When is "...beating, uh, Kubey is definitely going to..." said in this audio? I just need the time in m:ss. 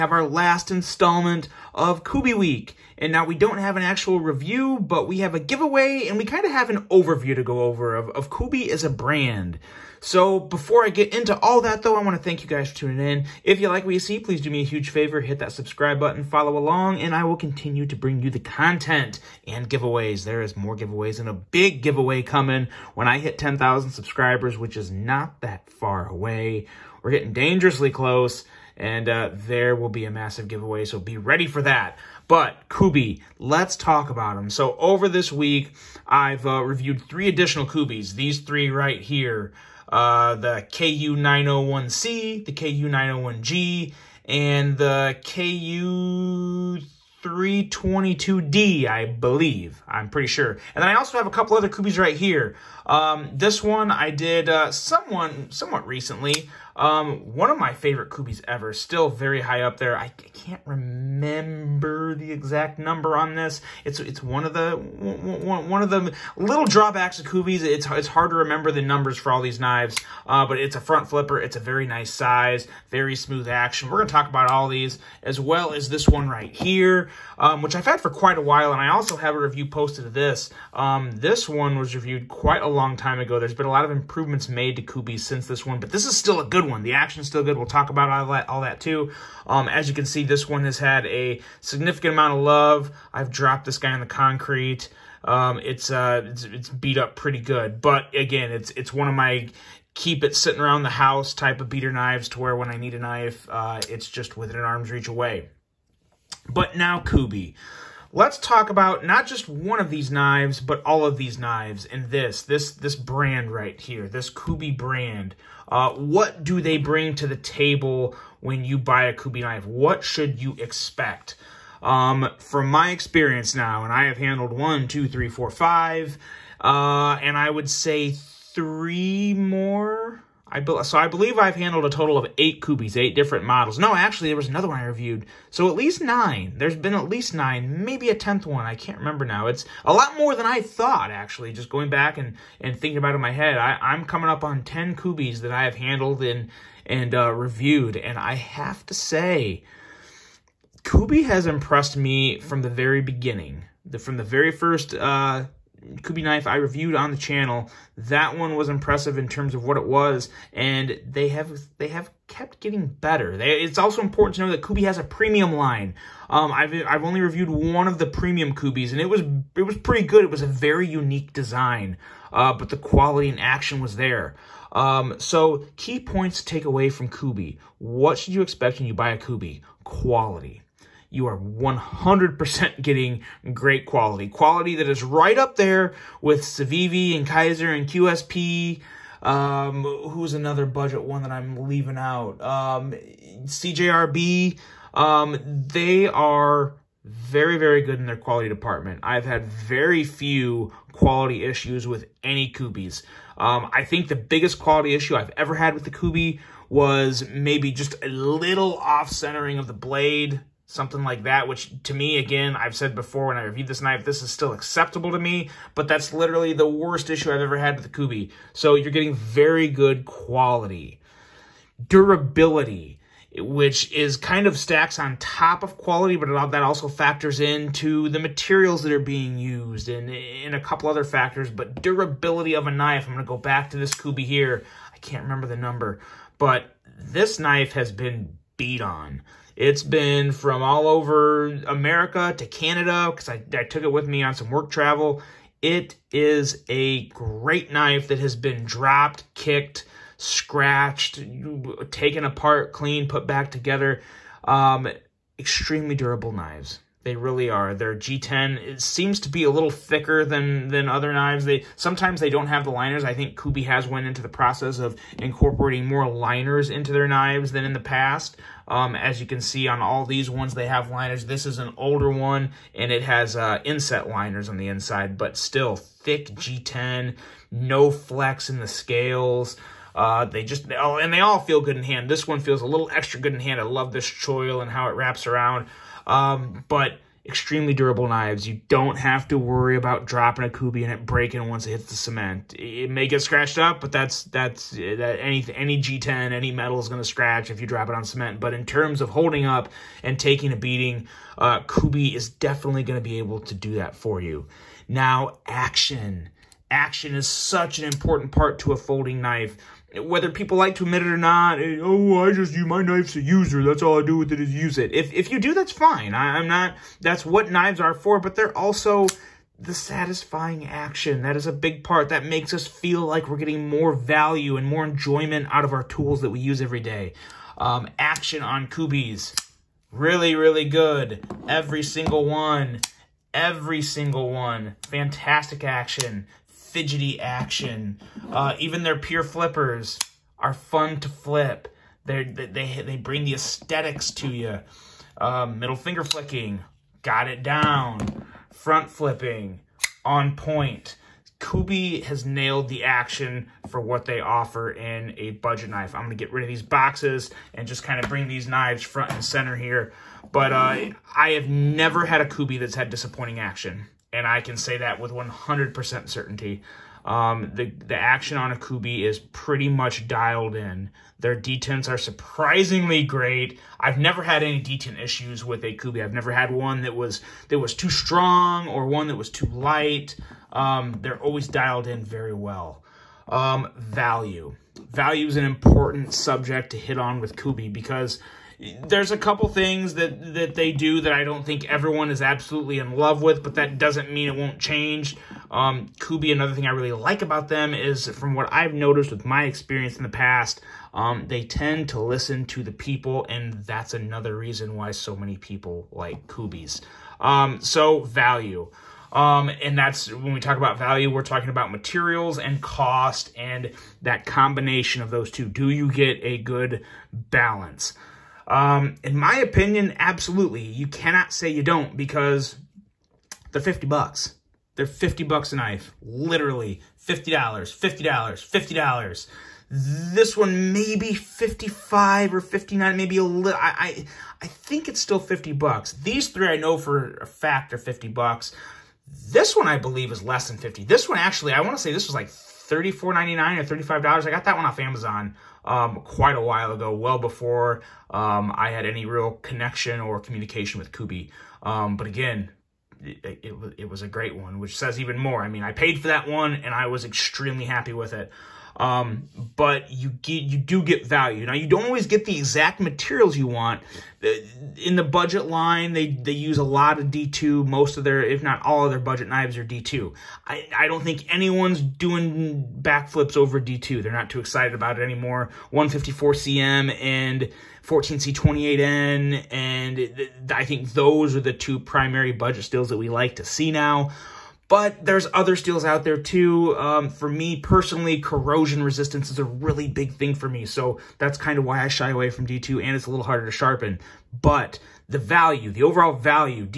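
5:00.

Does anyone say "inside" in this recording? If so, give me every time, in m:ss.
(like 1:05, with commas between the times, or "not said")
4:34.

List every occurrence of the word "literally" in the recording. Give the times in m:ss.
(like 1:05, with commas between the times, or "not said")
3:36, 7:06.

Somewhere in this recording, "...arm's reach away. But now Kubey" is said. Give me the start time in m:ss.
1:44.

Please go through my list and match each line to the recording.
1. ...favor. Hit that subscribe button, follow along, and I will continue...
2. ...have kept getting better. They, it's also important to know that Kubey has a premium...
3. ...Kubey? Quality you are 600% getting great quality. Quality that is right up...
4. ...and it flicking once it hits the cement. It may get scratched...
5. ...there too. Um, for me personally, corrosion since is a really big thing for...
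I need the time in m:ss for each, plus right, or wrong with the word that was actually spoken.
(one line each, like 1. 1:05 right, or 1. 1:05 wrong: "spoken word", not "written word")
1. 0:14 right
2. 2:41 right
3. 2:59 wrong: "100", not "600"
4. 4:50 wrong: "breaking", not "flicking"
5. 8:06 wrong: "resistance", not "since".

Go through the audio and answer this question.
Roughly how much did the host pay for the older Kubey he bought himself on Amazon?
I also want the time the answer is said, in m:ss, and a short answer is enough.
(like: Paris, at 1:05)
$34.99, at 7:22.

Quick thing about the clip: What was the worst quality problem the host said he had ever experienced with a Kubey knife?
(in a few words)
off-centering of the blade.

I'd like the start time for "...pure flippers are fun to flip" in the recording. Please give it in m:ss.
5:38.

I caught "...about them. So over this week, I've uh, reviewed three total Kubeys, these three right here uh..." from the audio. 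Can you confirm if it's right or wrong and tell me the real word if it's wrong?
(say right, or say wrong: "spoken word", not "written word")
wrong: "additional", not "total".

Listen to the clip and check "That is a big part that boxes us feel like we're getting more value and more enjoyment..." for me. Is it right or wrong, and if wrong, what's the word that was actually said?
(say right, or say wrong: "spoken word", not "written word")
wrong: "makes", not "boxes".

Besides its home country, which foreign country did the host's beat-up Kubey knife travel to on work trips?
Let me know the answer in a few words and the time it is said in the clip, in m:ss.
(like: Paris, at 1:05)
Canada, at 4:02.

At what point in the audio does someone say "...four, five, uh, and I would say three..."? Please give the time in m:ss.
2:05.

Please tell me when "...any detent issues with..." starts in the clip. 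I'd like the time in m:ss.
6:14.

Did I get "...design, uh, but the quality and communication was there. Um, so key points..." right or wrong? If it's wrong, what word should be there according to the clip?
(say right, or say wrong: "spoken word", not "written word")
wrong: "action", not "communication".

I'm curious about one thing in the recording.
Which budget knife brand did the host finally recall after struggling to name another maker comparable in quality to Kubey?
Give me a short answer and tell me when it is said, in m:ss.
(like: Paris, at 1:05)
CJRB, at 3:13.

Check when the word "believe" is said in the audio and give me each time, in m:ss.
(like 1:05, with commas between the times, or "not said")
0:49, 2:11, 7:19.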